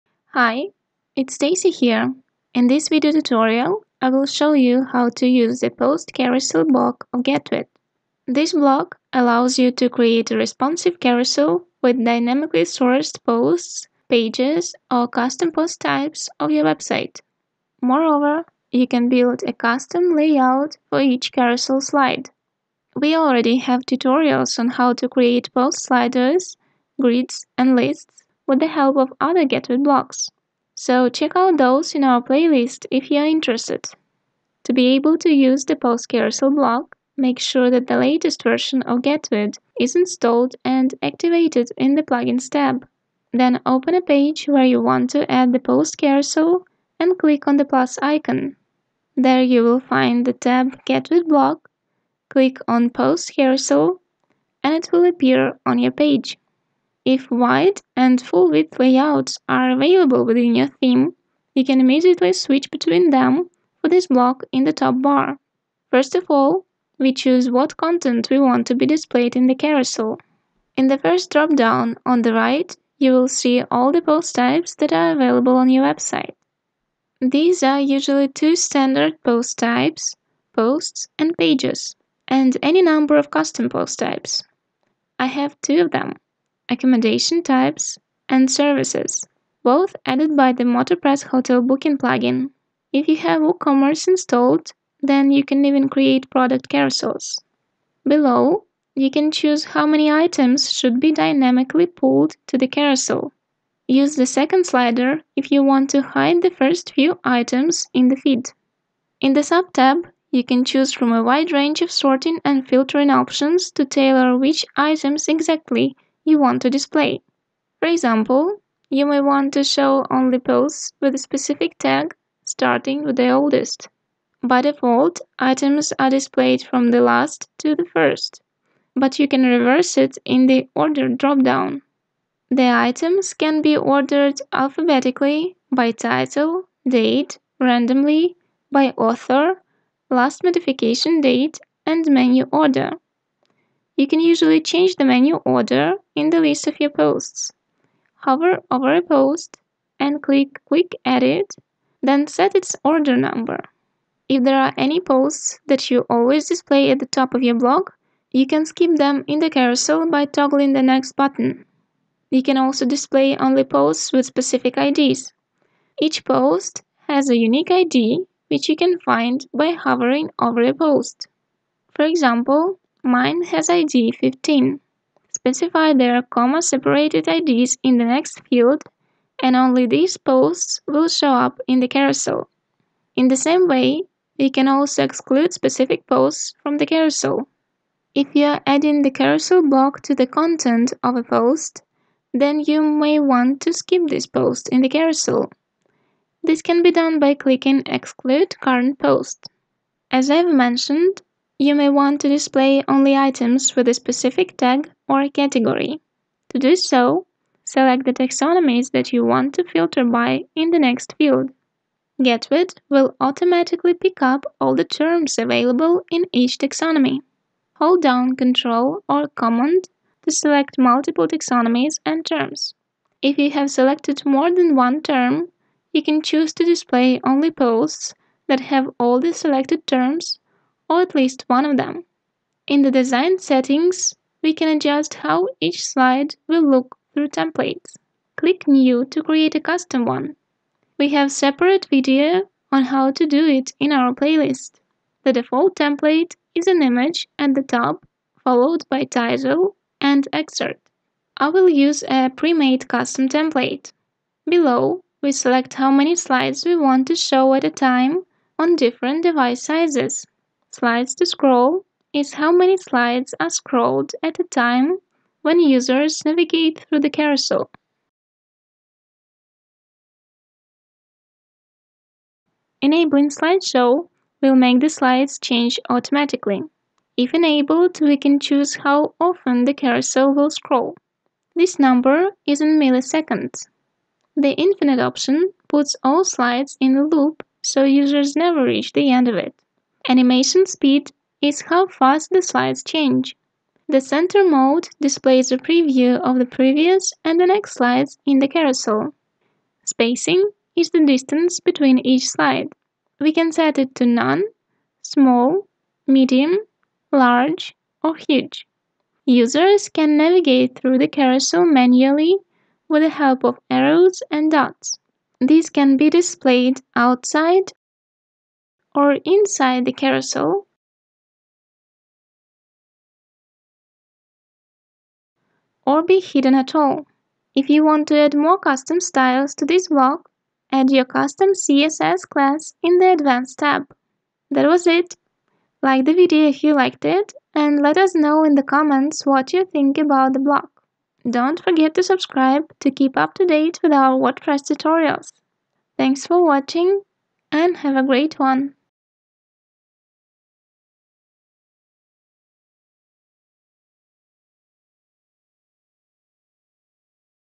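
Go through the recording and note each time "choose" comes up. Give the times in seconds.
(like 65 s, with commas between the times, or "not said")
67 s, 99 s, 110 s, 226 s, 278 s.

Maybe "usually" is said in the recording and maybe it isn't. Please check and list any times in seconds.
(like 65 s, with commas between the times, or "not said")
77 s, 144 s.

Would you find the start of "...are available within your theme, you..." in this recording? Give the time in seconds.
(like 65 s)
59 s.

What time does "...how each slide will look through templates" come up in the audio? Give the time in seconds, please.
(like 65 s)
235 s.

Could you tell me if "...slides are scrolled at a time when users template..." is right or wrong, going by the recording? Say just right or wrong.
wrong.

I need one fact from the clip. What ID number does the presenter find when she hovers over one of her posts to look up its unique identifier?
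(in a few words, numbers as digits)
15.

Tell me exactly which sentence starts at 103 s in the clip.
Use the second slider if you want to hide the first few items in the feed.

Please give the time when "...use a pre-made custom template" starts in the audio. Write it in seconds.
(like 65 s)
251 s.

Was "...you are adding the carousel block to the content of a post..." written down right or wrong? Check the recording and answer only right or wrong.
right.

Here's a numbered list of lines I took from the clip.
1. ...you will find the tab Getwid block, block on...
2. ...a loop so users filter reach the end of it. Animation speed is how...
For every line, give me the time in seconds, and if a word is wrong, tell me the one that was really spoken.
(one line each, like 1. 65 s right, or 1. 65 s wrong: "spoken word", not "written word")
1. 49 s wrong: "click", not "block"
2. 286 s wrong: "never", not "filter".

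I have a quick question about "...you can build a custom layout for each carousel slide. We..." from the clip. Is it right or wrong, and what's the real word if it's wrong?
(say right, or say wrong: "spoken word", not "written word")
right.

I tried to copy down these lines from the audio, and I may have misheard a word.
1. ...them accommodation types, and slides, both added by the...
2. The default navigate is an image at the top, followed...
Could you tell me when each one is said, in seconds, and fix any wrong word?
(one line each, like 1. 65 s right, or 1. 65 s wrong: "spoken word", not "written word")
1. 85 s wrong: "services", not "slides"
2. 245 s wrong: "template", not "navigate".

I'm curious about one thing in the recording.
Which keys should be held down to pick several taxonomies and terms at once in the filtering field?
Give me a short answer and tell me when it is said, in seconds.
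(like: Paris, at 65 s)
Ctrl or Command, at 218 s.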